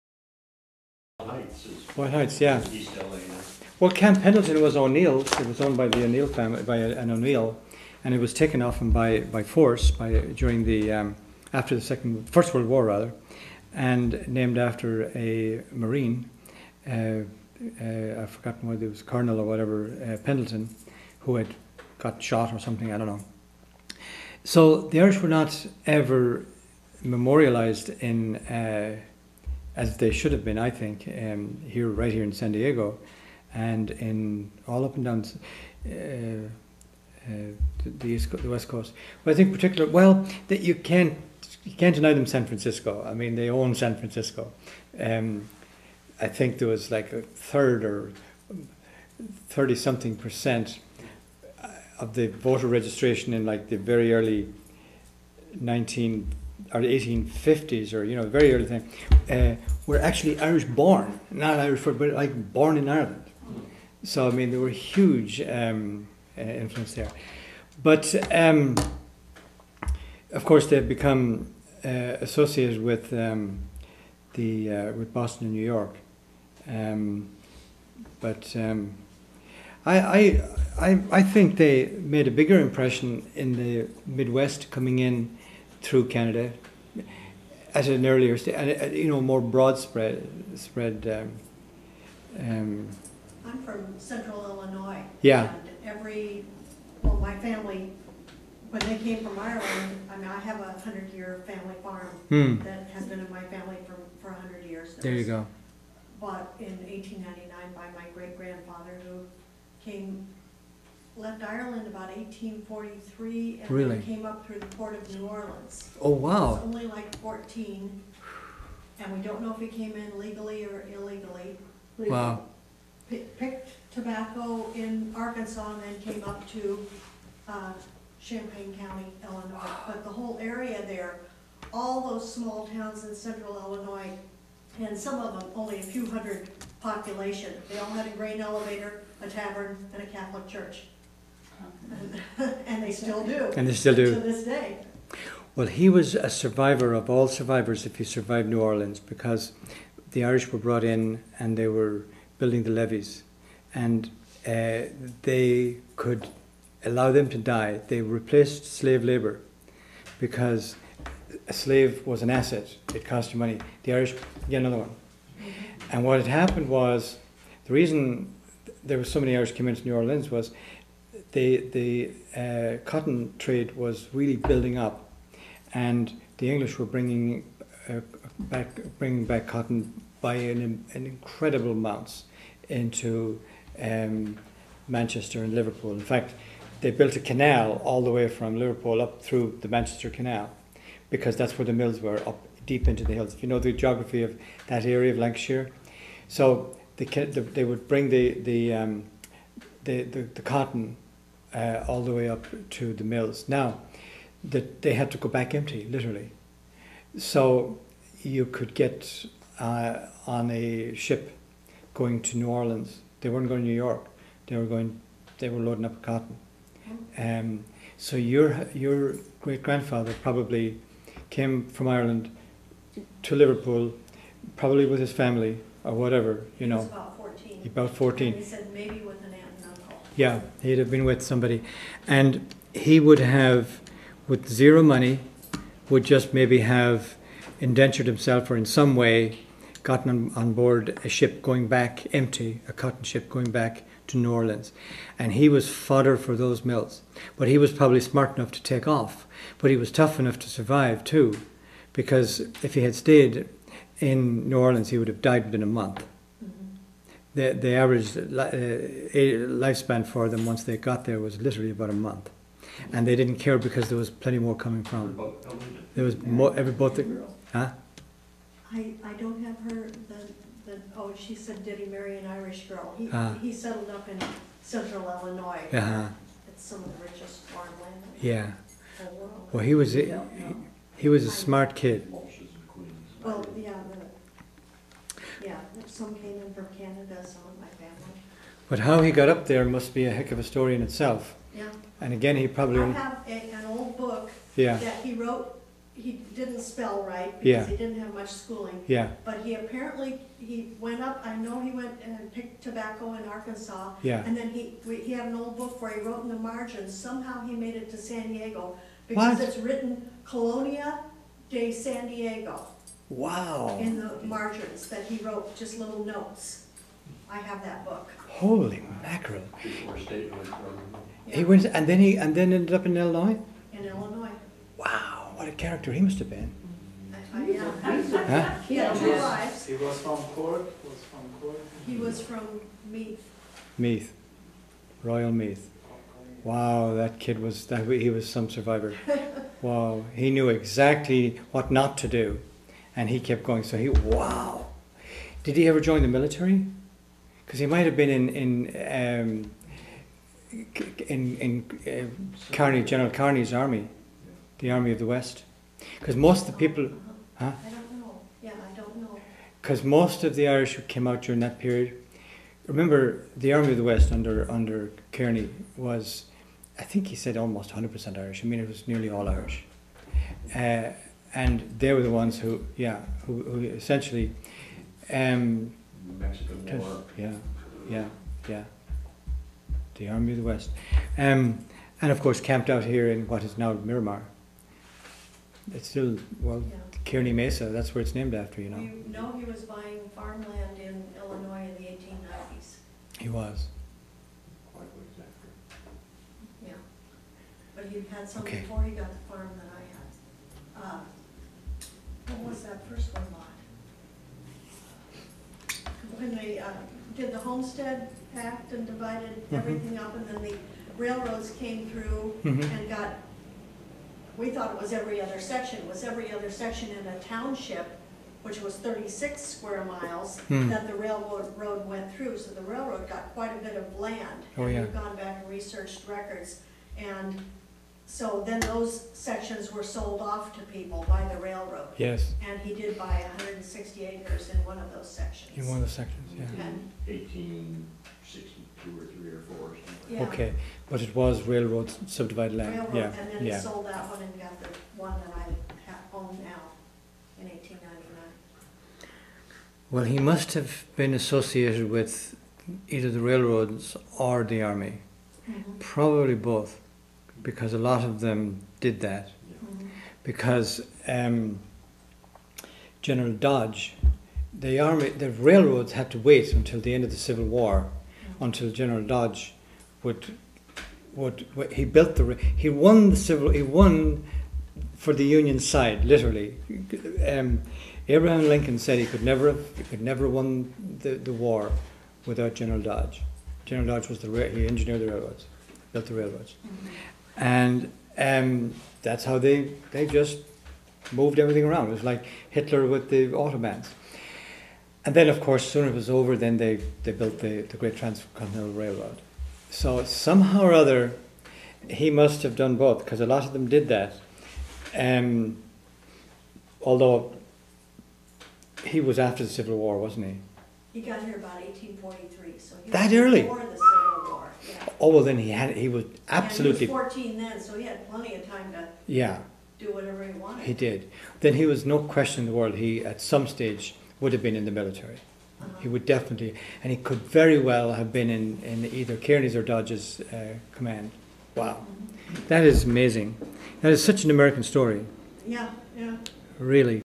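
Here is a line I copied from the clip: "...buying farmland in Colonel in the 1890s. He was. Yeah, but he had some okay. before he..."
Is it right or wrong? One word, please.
wrong.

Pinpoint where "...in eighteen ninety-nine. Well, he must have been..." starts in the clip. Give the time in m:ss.
7:27.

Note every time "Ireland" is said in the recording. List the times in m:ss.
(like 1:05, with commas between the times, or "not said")
1:02, 1:39, 1:51, 3:41.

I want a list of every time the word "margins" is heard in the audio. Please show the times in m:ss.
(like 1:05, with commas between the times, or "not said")
5:06, 5:14.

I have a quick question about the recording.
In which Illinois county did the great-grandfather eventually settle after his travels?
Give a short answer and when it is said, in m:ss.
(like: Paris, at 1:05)
Champaign County, at 2:08.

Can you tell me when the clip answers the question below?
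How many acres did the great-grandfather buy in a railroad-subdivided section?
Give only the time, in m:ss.
7:13.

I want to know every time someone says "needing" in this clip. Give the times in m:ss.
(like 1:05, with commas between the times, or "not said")
not said.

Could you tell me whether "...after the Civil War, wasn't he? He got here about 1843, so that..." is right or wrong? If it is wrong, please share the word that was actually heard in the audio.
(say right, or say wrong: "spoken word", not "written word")
right.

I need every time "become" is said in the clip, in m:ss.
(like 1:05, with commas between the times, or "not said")
1:10.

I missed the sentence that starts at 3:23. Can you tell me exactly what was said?
Now, that they had to go back empty, literally.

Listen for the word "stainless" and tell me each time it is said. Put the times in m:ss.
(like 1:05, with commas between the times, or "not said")
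not said.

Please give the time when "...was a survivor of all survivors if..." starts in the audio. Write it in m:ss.
2:25.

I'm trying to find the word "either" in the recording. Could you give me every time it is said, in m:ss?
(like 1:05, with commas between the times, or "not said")
7:32, 8:48.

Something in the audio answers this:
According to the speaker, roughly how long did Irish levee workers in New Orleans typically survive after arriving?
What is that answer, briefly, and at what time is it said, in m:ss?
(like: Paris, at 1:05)
About a month, at 4:21.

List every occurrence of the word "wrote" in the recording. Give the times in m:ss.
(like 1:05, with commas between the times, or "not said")
4:55, 5:06, 5:15.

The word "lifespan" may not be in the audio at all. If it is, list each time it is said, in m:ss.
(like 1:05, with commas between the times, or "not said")
4:18.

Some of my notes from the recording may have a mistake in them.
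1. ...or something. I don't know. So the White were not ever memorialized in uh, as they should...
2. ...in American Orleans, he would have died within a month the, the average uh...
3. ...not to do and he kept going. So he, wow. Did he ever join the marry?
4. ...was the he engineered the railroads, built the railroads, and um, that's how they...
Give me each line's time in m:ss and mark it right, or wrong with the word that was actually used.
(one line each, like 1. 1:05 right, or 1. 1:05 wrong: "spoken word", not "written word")
1. 0:22 wrong: "Irish", not "White"
2. 4:13 wrong: "New", not "American"
3. 5:41 wrong: "military", not "marry"
4. 8:04 right.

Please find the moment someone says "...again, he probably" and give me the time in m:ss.
4:52.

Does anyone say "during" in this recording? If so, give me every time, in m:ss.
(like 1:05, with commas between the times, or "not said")
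0:10, 6:01.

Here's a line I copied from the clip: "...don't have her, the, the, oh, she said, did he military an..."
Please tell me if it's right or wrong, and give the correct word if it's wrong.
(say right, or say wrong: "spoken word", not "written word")
wrong: "marry", not "military".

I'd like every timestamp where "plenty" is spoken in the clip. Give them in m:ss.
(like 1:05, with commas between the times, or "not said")
4:24, 8:38.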